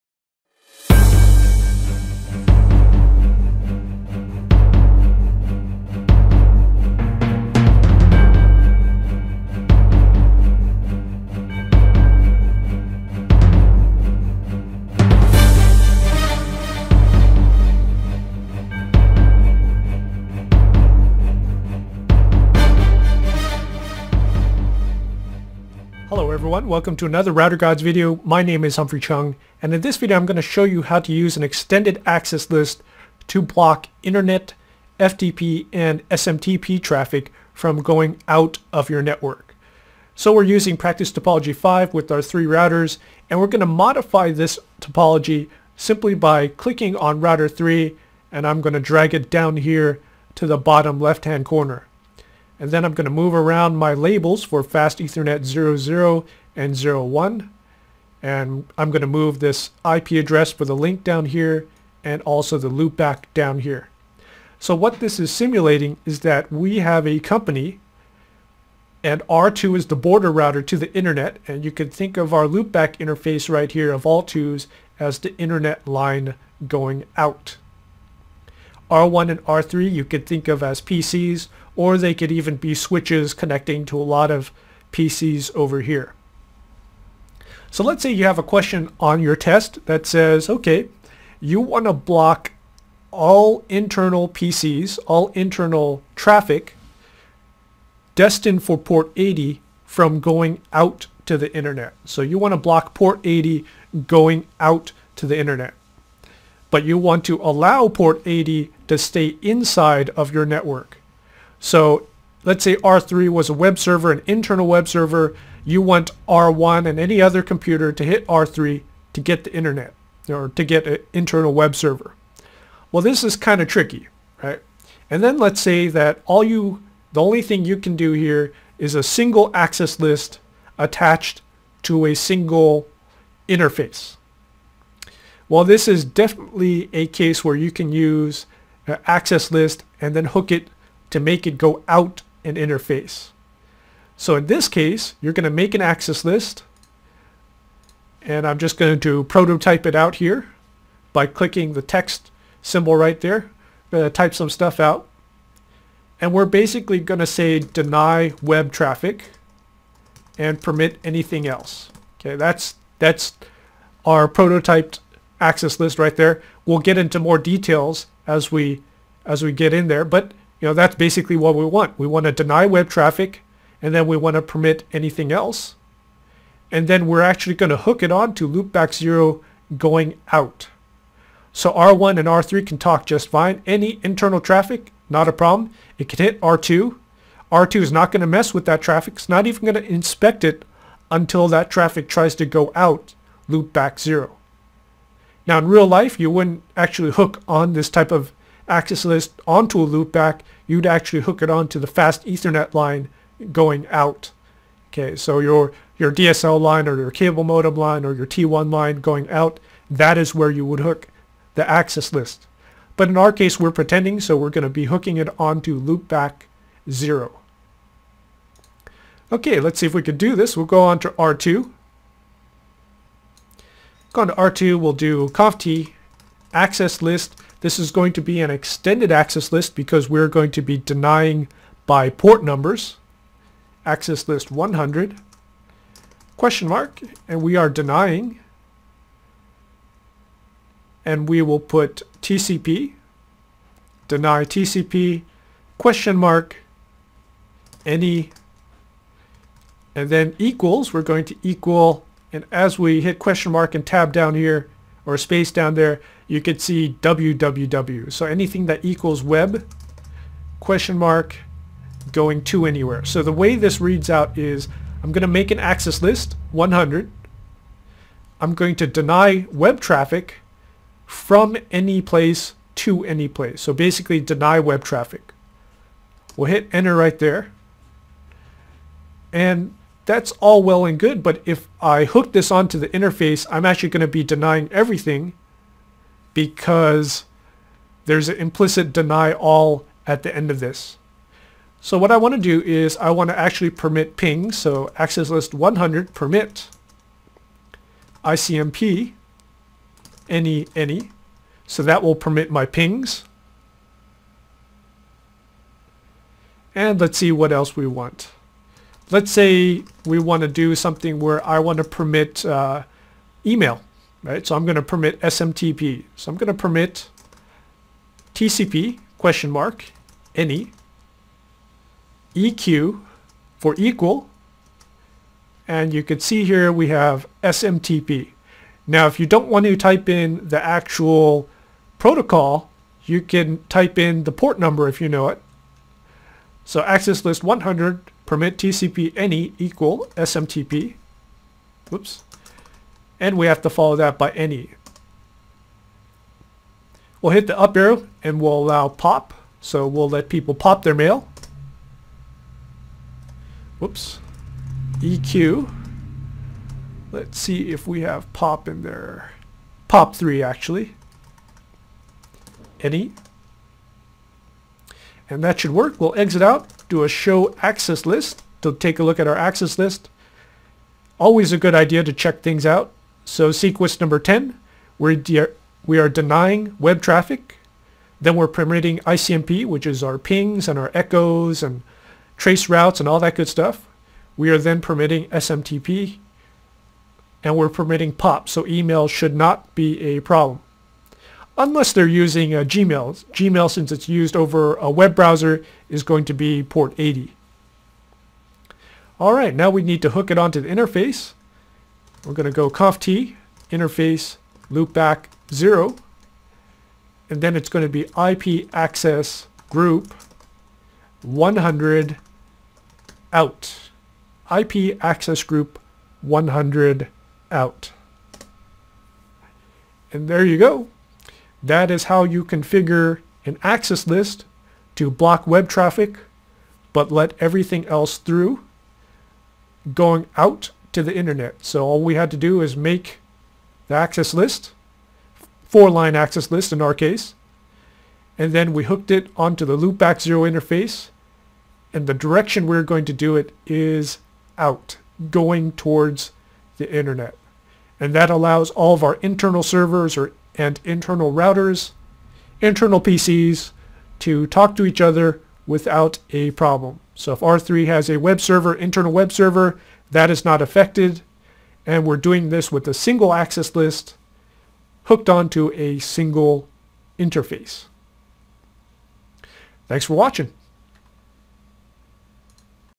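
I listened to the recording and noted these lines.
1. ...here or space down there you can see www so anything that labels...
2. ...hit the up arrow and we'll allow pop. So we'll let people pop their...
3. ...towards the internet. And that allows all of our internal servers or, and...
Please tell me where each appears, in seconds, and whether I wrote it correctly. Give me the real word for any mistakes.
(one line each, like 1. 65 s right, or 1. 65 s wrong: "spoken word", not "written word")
1. 254 s wrong: "equals", not "labels"
2. 347 s right
3. 445 s right.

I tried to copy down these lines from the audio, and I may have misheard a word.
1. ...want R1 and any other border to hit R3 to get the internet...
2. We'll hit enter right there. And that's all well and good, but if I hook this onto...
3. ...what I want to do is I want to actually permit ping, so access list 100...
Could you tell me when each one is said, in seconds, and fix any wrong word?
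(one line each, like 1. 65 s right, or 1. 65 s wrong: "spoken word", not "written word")
1. 115 s wrong: "computer", not "border"
2. 276 s right
3. 291 s right.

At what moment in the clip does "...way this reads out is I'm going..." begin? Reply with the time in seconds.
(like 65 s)
263 s.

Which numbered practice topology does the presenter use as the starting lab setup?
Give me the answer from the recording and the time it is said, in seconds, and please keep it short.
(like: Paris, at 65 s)
Practice Topology 5, at 40 s.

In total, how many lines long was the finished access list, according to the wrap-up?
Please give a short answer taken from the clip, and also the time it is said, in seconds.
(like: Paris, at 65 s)
4, at 435 s.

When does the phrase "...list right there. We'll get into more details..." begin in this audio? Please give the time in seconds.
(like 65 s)
165 s.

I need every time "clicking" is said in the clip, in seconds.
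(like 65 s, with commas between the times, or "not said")
46 s, 151 s.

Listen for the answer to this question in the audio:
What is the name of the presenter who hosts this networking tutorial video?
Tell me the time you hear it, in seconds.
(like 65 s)
28 s.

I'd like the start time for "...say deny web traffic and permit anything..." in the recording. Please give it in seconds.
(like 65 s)
157 s.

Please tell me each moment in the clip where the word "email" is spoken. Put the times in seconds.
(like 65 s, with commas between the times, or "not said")
313 s, 388 s.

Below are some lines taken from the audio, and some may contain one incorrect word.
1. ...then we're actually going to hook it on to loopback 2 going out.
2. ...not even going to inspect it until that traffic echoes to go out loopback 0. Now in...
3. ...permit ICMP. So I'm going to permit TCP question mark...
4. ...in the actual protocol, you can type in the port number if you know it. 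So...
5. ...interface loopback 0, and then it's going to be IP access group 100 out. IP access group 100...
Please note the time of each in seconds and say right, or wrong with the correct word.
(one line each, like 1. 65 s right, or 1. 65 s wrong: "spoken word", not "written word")
1. 176 s wrong: "0", not "2"
2. 189 s wrong: "tries", not "echoes"
3. 314 s wrong: "SMTP", not "ICMP"
4. 330 s right
5. 403 s right.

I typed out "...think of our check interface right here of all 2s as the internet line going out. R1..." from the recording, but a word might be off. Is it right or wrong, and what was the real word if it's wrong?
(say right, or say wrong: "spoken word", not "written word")
wrong: "loopback", not "check".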